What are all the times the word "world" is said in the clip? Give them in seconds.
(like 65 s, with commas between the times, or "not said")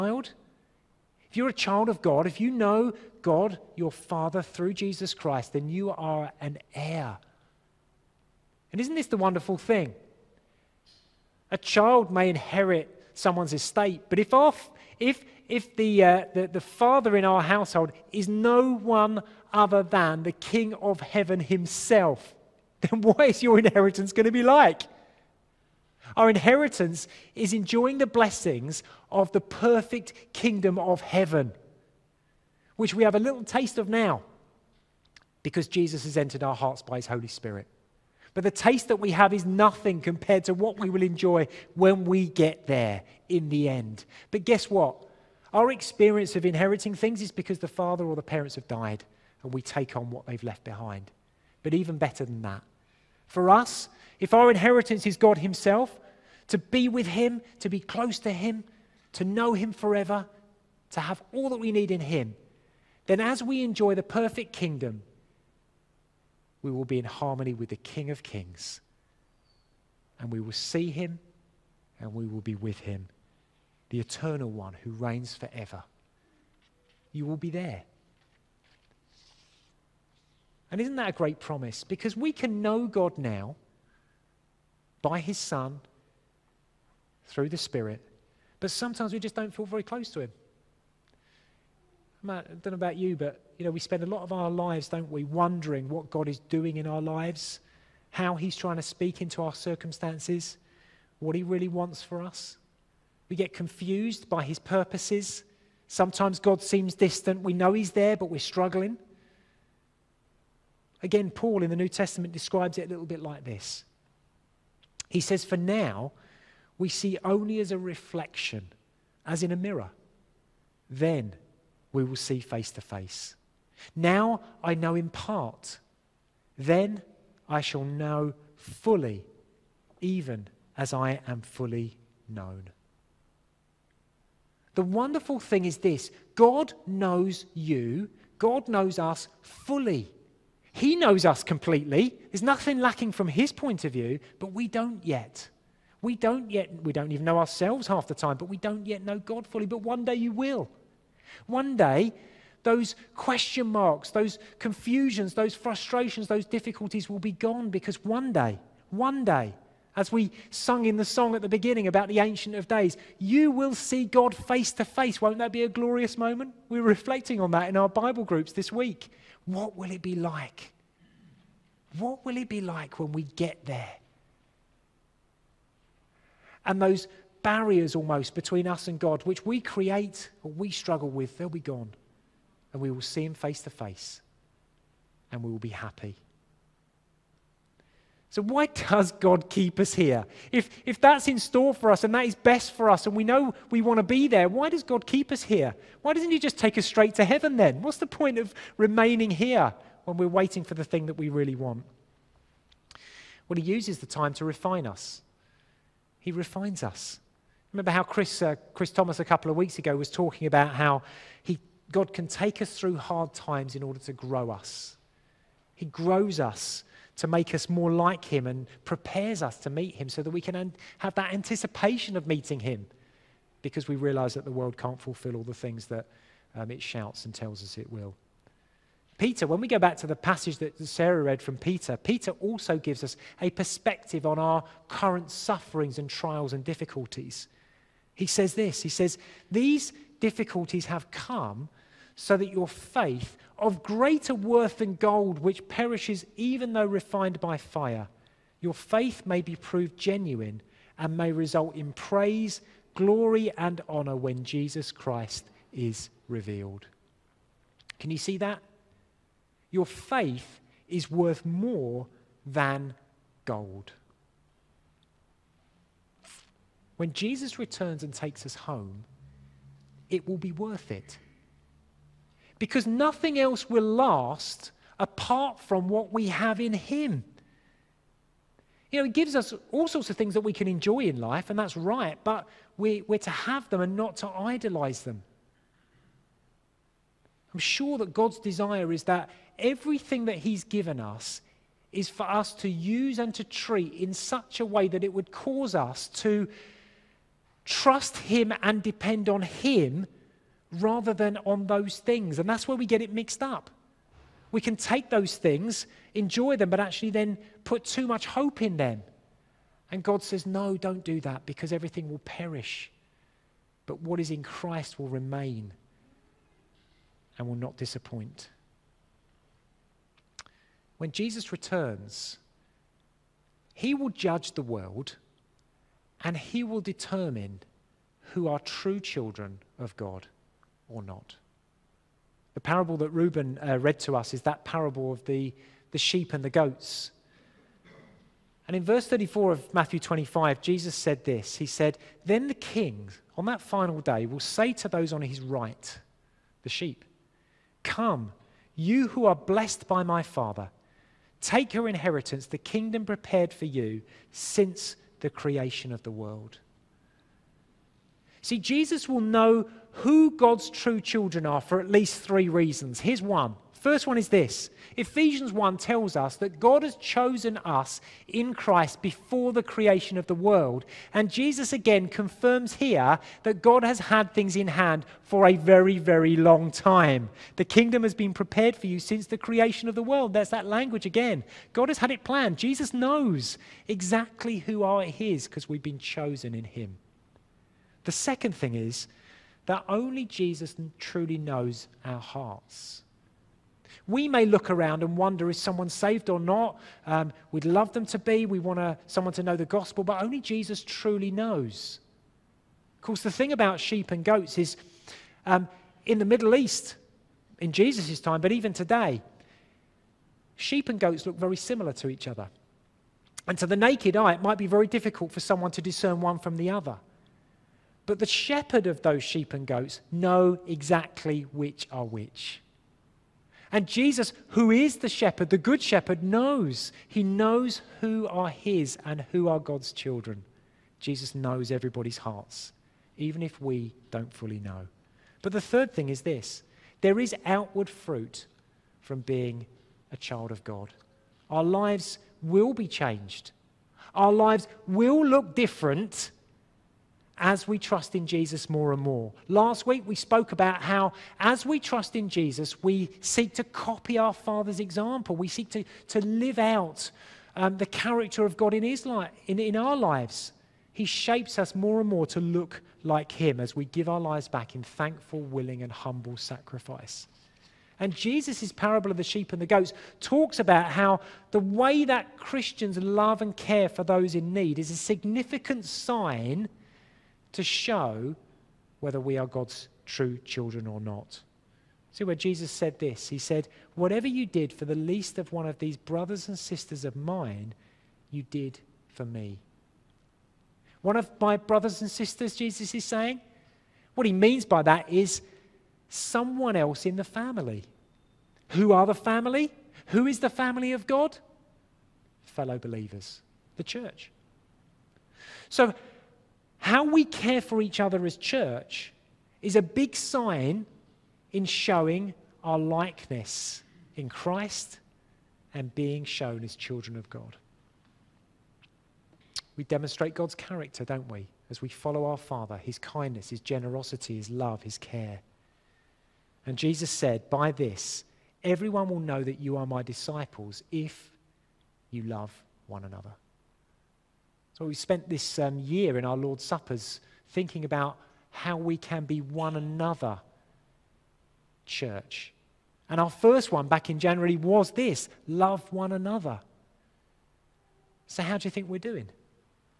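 224 s, 324 s, 356 s, 370 s, 380 s.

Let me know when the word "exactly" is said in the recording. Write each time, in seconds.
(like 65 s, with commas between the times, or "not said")
383 s, 420 s.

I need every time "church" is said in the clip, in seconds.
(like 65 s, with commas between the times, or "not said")
503 s, 508 s, 541 s.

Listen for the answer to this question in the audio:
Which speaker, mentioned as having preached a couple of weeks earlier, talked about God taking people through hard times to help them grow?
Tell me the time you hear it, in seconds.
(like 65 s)
208 s.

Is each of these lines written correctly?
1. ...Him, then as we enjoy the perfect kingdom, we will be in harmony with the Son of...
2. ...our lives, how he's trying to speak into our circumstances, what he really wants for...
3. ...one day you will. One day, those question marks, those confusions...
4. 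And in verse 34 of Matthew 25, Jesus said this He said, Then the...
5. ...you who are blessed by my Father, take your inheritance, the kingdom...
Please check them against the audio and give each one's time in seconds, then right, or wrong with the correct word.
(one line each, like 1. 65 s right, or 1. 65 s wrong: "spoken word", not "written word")
1. 62 s wrong: "King", not "Son"
2. 96 s right
3. 149 s right
4. 338 s right
5. 348 s right.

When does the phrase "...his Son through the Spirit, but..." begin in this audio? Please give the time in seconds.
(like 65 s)
85 s.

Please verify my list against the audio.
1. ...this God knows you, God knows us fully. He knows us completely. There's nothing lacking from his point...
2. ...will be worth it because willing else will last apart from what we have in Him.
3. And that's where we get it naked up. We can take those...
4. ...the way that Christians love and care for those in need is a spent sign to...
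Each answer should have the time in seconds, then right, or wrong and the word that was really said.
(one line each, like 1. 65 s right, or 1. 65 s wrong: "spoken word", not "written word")
1. 135 s right
2. 270 s wrong: "nothing", not "willing"
3. 302 s wrong: "mixed", not "naked"
4. 471 s wrong: "significant", not "spent".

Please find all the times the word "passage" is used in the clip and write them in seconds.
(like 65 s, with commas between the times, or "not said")
230 s.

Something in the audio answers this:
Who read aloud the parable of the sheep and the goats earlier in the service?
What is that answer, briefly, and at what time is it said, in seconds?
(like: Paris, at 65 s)
Reuben, at 333 s.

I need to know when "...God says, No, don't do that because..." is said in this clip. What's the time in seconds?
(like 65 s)
310 s.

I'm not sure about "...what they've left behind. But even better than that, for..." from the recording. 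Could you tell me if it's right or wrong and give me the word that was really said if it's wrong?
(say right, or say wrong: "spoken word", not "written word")
right.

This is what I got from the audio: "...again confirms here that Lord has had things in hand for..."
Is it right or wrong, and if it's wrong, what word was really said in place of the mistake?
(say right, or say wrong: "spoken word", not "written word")
wrong: "God", not "Lord".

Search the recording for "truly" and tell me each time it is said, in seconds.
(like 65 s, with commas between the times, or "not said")
390 s, 400 s.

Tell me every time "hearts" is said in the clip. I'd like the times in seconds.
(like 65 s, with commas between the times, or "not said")
36 s, 392 s, 432 s.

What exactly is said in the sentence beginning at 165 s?
Won't that be a glorious moment?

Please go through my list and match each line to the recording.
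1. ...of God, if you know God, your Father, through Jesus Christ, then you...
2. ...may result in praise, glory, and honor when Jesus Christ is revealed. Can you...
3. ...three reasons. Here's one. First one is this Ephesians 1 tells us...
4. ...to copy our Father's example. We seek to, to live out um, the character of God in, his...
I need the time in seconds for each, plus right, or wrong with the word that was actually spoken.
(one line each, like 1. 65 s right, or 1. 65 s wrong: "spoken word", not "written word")
1. 1 s right
2. 251 s right
3. 362 s right
4. 453 s right.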